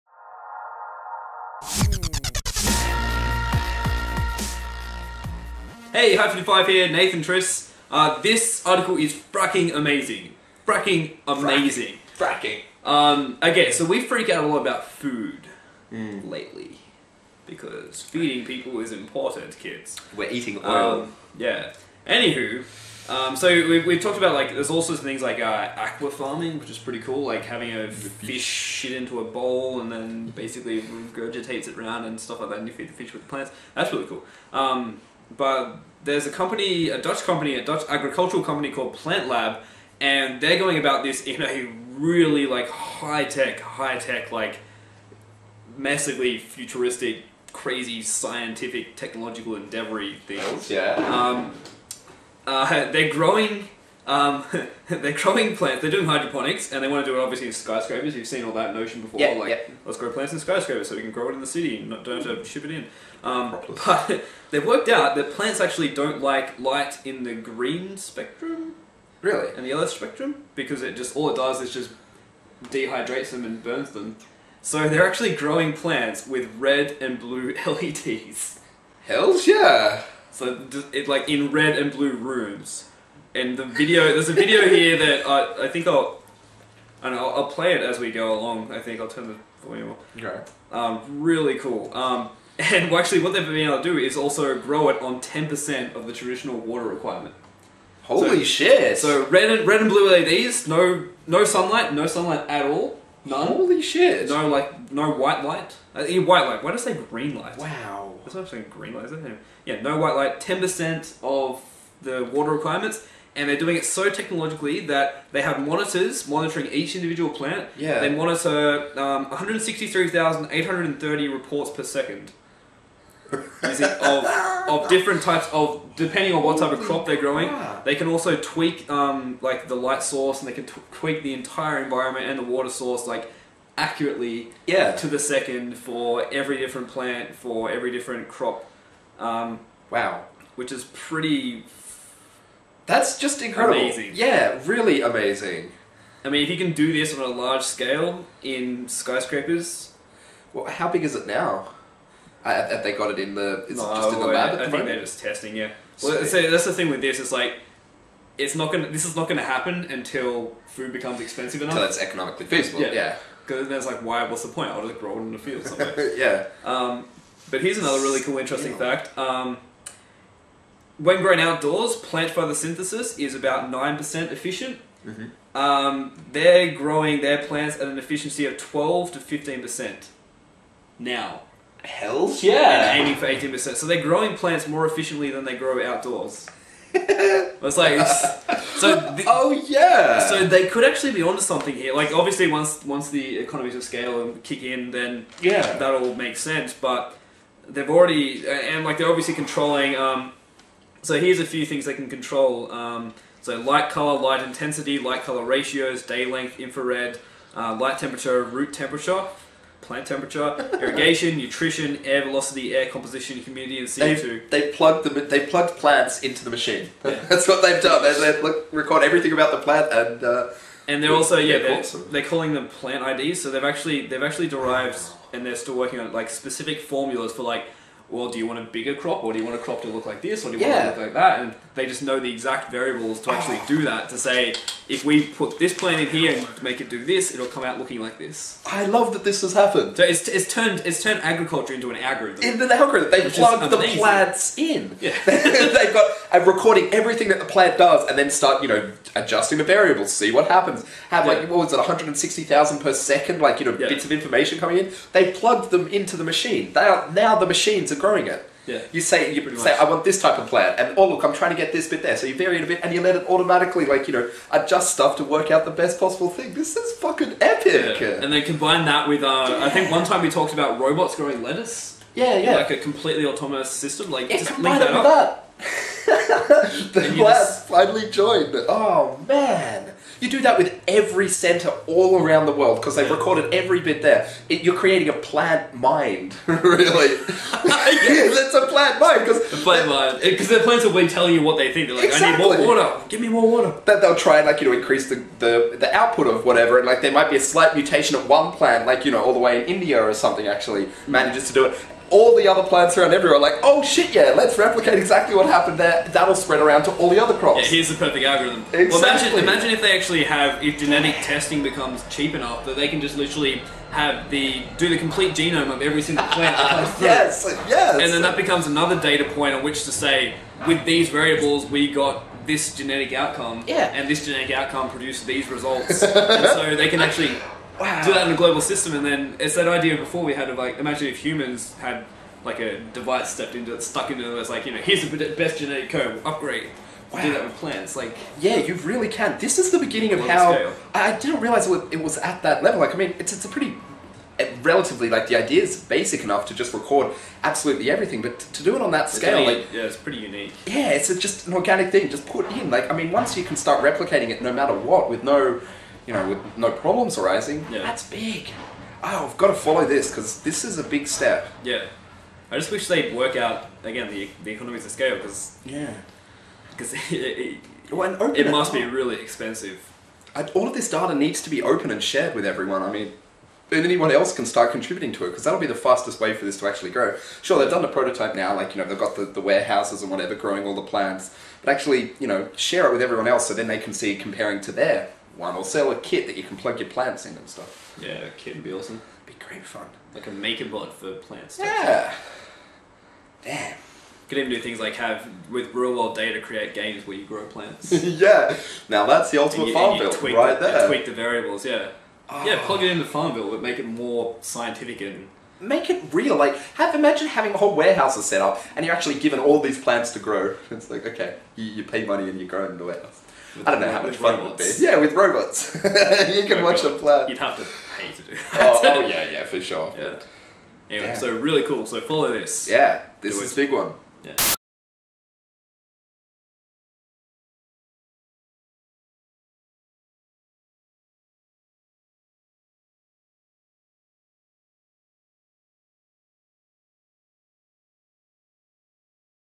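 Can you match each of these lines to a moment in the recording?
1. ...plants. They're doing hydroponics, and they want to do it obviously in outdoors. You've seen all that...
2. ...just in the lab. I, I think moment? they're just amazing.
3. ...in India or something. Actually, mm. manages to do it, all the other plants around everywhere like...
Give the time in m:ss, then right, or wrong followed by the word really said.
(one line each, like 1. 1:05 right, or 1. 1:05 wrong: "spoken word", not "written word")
1. 0:55 wrong: "skyscrapers", not "outdoors"
2. 2:33 wrong: "testing", not "amazing"
3. 4:59 right.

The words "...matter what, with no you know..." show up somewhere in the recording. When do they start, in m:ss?
5:54.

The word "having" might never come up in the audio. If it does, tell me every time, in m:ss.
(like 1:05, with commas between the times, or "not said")
0:27, 6:47.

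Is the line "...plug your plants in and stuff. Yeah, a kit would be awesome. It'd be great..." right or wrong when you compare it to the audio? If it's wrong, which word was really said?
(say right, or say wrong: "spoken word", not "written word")
right.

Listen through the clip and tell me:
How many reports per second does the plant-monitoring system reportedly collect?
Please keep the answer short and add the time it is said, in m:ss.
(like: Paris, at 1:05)
163,830, at 1:59.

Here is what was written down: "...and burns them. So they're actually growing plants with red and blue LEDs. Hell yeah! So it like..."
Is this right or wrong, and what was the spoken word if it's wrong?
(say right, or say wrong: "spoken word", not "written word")
right.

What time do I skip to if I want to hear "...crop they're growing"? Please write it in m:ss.
2:06.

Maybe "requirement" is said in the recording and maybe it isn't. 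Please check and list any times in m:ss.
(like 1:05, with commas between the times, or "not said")
1:36, 1:52.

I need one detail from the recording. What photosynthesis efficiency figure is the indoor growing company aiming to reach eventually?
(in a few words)
18%.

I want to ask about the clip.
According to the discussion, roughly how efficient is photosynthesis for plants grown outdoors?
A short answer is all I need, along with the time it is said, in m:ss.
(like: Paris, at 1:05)
9%, at 2:53.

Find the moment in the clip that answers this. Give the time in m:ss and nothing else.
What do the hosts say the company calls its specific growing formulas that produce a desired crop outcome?
3:42.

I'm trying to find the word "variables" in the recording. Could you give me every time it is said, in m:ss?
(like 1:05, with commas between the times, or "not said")
3:52, 4:09, 5:21, 6:41.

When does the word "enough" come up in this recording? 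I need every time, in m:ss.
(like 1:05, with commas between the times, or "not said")
2:41, 5:12, 5:46.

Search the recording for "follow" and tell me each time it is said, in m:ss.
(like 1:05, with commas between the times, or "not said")
5:59, 7:02.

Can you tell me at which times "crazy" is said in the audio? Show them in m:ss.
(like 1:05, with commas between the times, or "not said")
0:47.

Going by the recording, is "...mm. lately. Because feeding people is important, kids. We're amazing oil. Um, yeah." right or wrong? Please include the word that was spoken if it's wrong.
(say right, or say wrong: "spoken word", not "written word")
wrong: "eating", not "amazing".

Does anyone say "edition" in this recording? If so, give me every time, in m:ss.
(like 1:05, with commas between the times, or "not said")
not said.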